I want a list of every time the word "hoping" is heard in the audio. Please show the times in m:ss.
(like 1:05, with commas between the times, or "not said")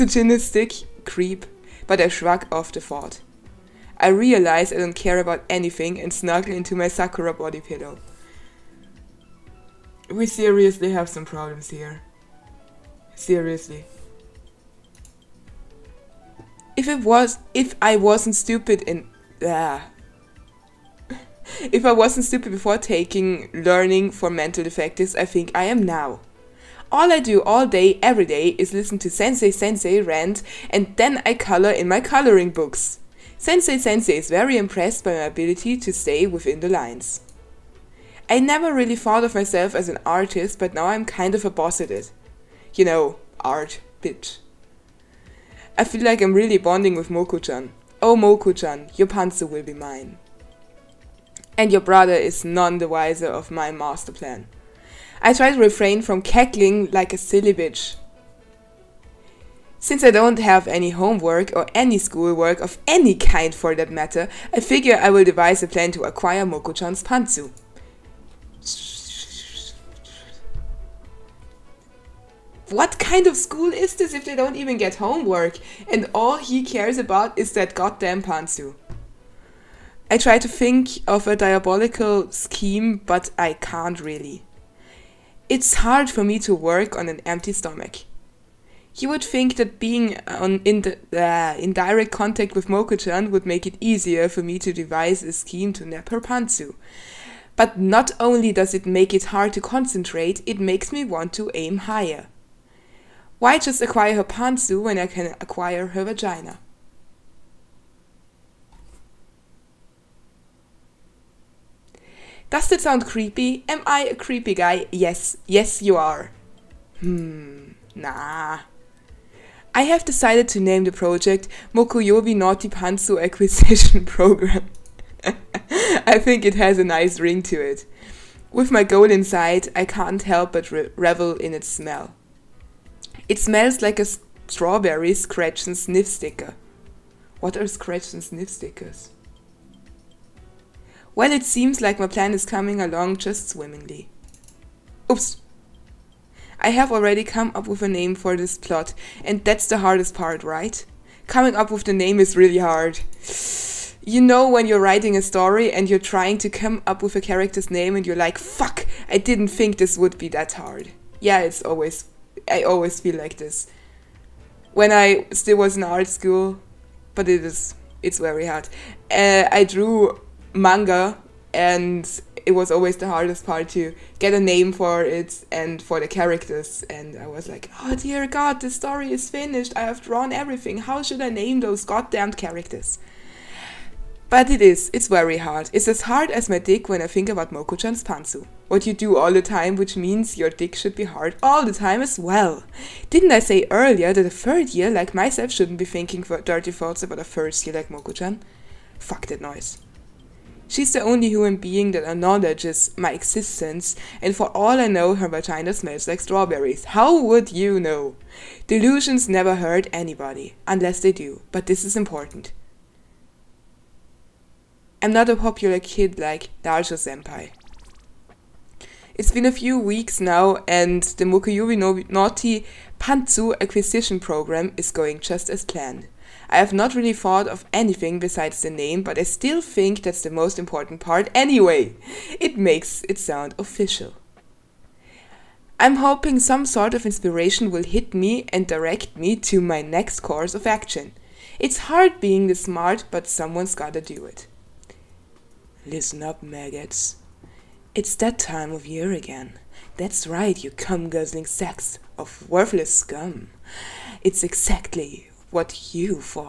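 3:55.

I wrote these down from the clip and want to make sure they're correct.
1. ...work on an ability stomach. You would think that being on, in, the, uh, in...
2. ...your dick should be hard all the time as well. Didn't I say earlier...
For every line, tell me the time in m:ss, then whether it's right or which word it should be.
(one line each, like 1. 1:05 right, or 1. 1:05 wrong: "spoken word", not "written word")
1. 1:26 wrong: "empty", not "ability"
2. 3:10 right.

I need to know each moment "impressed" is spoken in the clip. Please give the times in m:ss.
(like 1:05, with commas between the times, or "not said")
0:34.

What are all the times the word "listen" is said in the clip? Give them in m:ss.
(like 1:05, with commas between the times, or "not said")
0:28, 4:05.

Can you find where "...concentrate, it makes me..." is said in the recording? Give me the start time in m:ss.
1:39.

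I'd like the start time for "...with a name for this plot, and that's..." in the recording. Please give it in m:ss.
2:27.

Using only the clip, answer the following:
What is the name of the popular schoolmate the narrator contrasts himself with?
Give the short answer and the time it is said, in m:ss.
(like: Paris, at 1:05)
Naruto Senpai, at 3:36.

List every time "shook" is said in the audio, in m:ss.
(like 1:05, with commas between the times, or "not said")
not said.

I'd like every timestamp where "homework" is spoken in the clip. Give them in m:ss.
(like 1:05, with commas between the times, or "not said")
1:00, 1:14.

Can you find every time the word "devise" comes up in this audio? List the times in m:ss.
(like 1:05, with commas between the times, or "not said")
1:05, 1:34.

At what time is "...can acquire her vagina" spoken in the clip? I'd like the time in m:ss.
1:45.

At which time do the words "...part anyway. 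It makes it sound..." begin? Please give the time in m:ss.
3:50.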